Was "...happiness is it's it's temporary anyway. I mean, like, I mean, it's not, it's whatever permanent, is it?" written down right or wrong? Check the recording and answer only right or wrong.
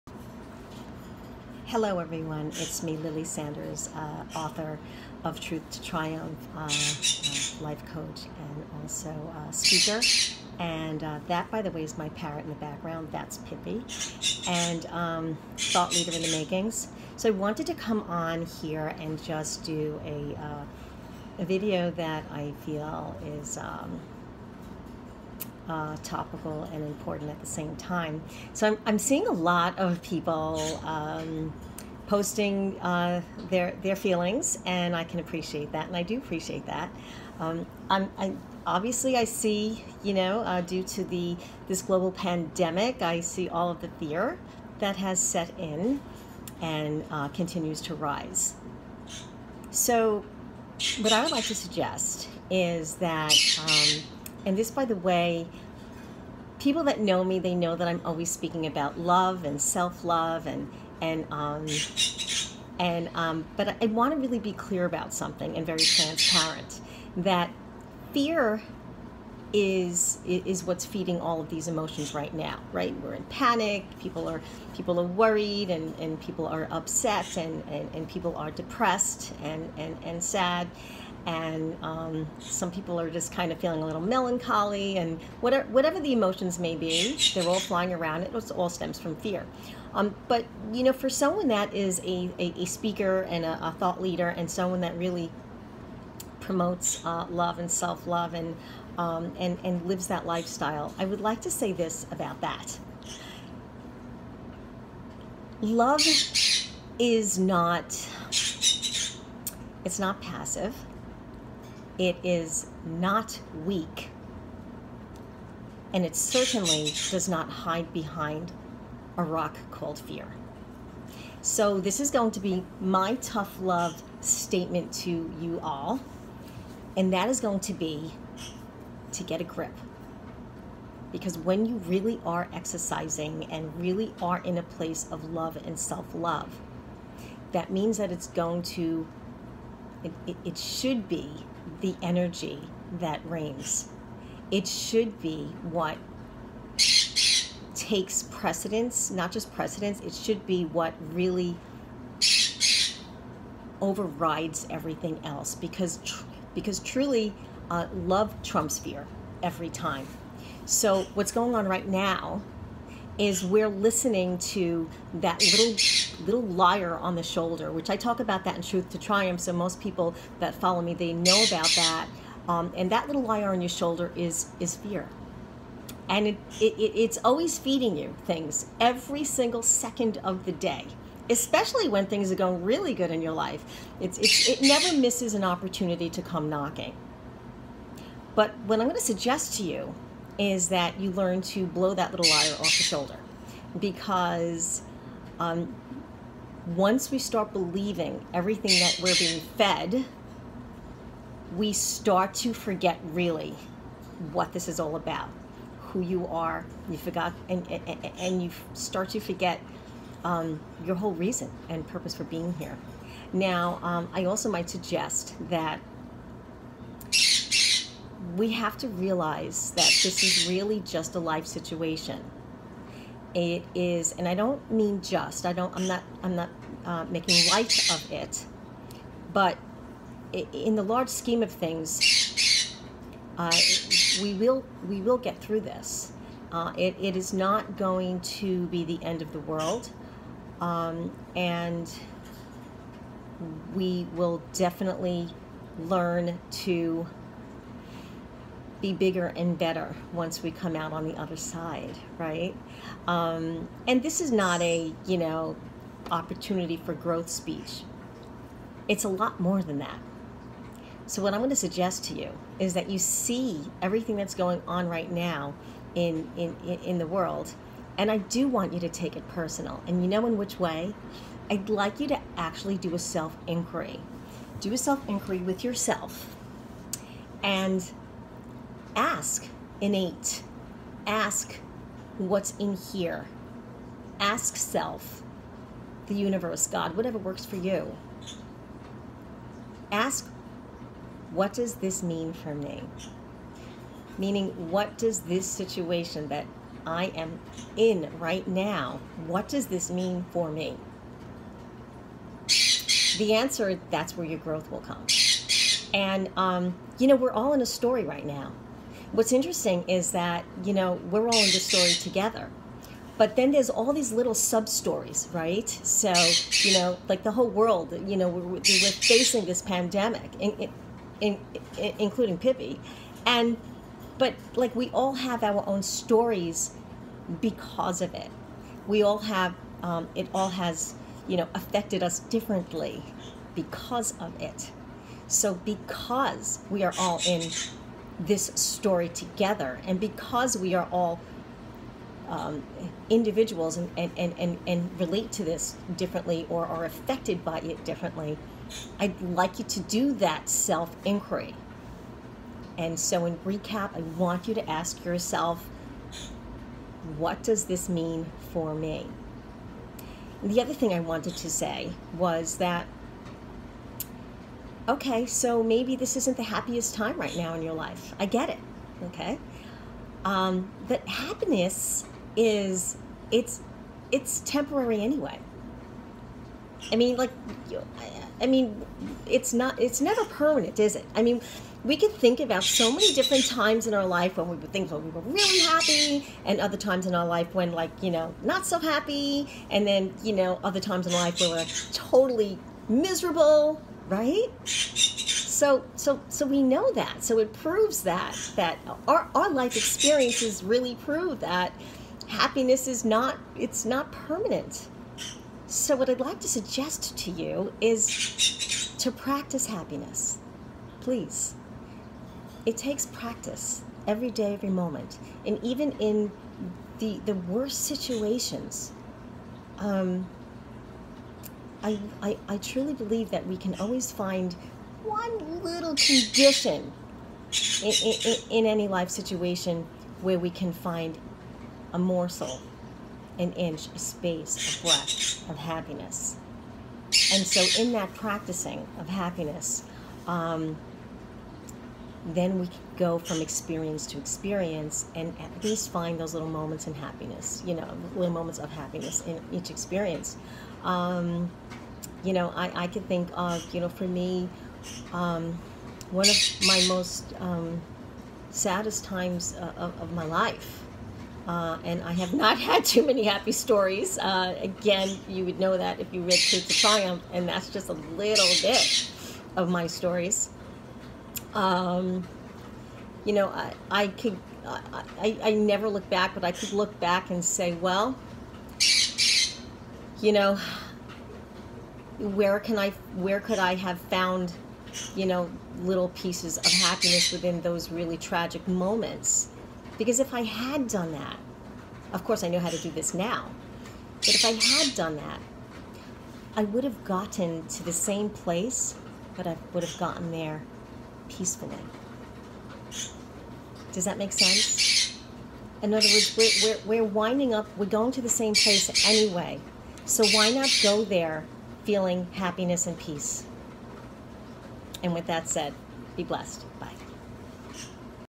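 wrong.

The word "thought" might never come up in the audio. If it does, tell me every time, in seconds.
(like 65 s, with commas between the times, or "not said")
15 s, 93 s.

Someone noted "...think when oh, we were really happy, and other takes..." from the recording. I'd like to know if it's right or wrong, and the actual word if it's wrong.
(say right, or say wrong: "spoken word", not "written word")
wrong: "times", not "takes".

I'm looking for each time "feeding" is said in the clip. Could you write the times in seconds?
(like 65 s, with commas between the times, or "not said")
70 s, 177 s.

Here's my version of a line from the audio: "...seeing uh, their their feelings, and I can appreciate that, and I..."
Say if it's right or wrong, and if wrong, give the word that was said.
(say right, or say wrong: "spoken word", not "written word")
wrong: "posting", not "seeing".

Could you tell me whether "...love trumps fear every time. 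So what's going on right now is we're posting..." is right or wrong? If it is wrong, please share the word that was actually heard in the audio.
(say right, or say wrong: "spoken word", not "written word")
wrong: "listening", not "posting".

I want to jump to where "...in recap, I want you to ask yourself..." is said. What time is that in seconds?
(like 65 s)
353 s.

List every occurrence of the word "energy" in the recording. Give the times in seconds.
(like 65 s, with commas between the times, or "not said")
142 s.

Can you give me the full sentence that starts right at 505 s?
In other words, we're, we're, we're winding up, we're going to the same place anyway.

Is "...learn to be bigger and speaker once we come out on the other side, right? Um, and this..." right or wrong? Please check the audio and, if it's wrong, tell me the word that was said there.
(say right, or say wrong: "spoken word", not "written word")
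wrong: "better", not "speaker".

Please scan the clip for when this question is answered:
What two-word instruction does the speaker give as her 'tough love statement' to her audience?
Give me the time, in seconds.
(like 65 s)
129 s.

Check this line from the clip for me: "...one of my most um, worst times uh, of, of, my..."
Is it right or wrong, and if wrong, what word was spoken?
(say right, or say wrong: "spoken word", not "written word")
wrong: "saddest", not "worst".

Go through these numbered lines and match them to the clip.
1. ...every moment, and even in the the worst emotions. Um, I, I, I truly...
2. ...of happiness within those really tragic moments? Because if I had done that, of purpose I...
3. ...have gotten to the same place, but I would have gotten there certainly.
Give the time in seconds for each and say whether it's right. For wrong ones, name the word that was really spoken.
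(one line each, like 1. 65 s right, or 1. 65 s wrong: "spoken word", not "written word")
1. 414 s wrong: "situations", not "emotions"
2. 486 s wrong: "course", not "purpose"
3. 496 s wrong: "peacefully", not "certainly".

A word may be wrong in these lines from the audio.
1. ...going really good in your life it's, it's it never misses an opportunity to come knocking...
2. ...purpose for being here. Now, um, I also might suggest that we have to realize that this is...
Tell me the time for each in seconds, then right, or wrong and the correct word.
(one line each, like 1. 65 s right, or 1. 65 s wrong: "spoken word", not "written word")
1. 182 s right
2. 211 s right.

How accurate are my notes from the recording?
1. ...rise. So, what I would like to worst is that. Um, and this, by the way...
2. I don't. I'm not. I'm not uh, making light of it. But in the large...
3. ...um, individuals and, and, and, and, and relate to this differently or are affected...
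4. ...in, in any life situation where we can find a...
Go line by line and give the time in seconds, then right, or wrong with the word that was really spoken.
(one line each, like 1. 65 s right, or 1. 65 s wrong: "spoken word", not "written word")
1. 47 s wrong: "suggest", not "worst"
2. 225 s right
3. 342 s right
4. 427 s right.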